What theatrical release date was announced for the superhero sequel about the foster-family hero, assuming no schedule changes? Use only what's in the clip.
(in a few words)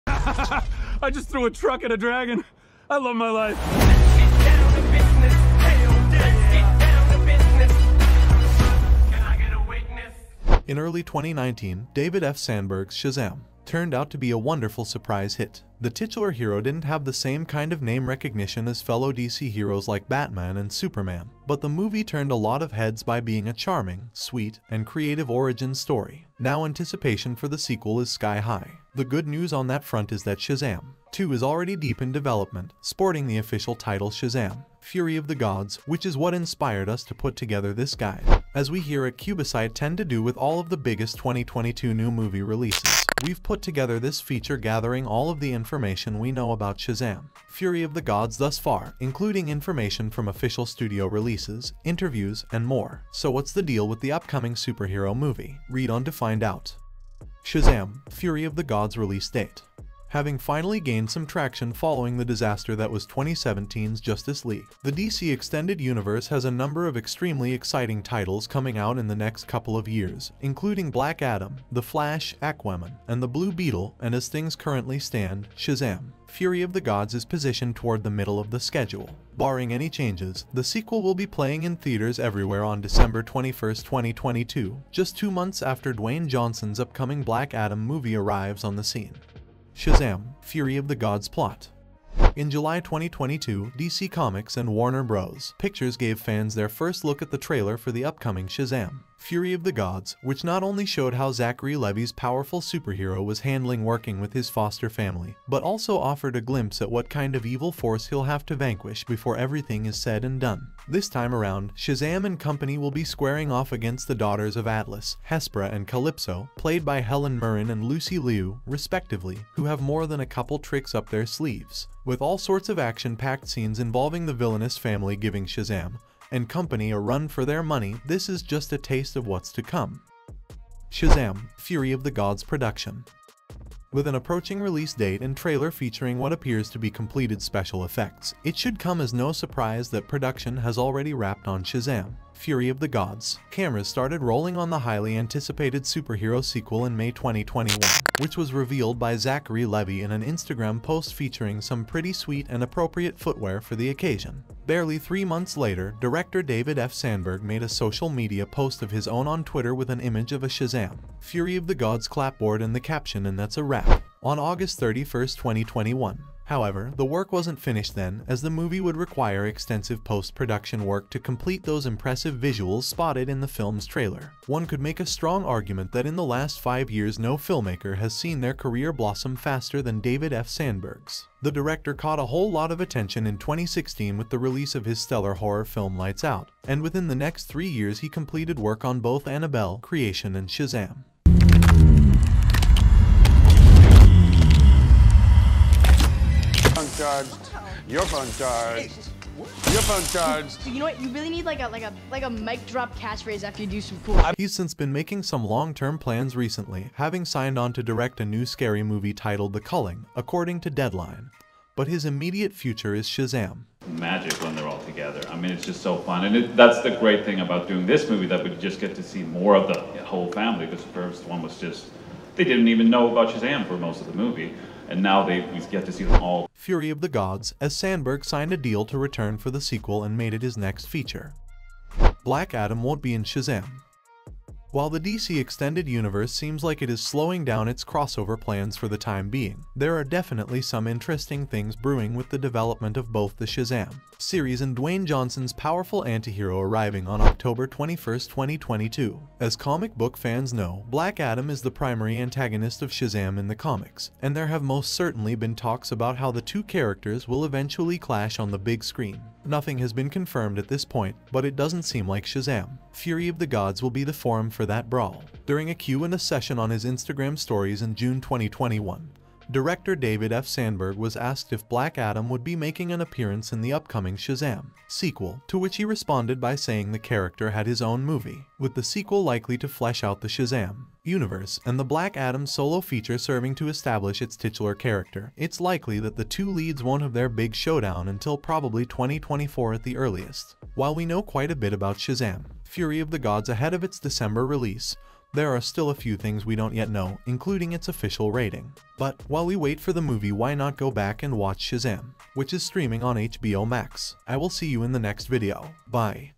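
December 21, 2022.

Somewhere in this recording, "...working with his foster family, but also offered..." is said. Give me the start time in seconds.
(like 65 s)
103 s.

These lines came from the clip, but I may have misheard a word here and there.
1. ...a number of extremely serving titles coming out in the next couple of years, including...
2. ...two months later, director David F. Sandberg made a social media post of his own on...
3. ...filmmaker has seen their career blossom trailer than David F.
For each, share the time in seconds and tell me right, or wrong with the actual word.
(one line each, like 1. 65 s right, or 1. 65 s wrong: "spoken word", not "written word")
1. 66 s wrong: "exciting", not "serving"
2. 154 s wrong: "three", not "two"
3. 177 s wrong: "faster", not "trailer".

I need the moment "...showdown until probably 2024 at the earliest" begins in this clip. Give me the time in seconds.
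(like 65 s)
287 s.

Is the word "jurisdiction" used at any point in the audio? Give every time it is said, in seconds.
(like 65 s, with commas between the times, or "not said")
not said.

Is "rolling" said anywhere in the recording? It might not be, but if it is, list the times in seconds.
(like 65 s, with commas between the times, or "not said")
144 s.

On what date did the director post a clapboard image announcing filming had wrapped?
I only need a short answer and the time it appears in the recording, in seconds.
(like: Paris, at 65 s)
August 31, 2021, at 164 s.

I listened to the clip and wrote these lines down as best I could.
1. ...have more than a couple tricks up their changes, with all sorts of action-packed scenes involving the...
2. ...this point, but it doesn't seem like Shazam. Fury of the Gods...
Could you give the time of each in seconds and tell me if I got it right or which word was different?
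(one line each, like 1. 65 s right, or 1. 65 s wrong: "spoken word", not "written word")
1. 119 s wrong: "sleeves", not "changes"
2. 260 s right.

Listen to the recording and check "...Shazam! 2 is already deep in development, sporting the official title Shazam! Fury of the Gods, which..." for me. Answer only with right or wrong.
right.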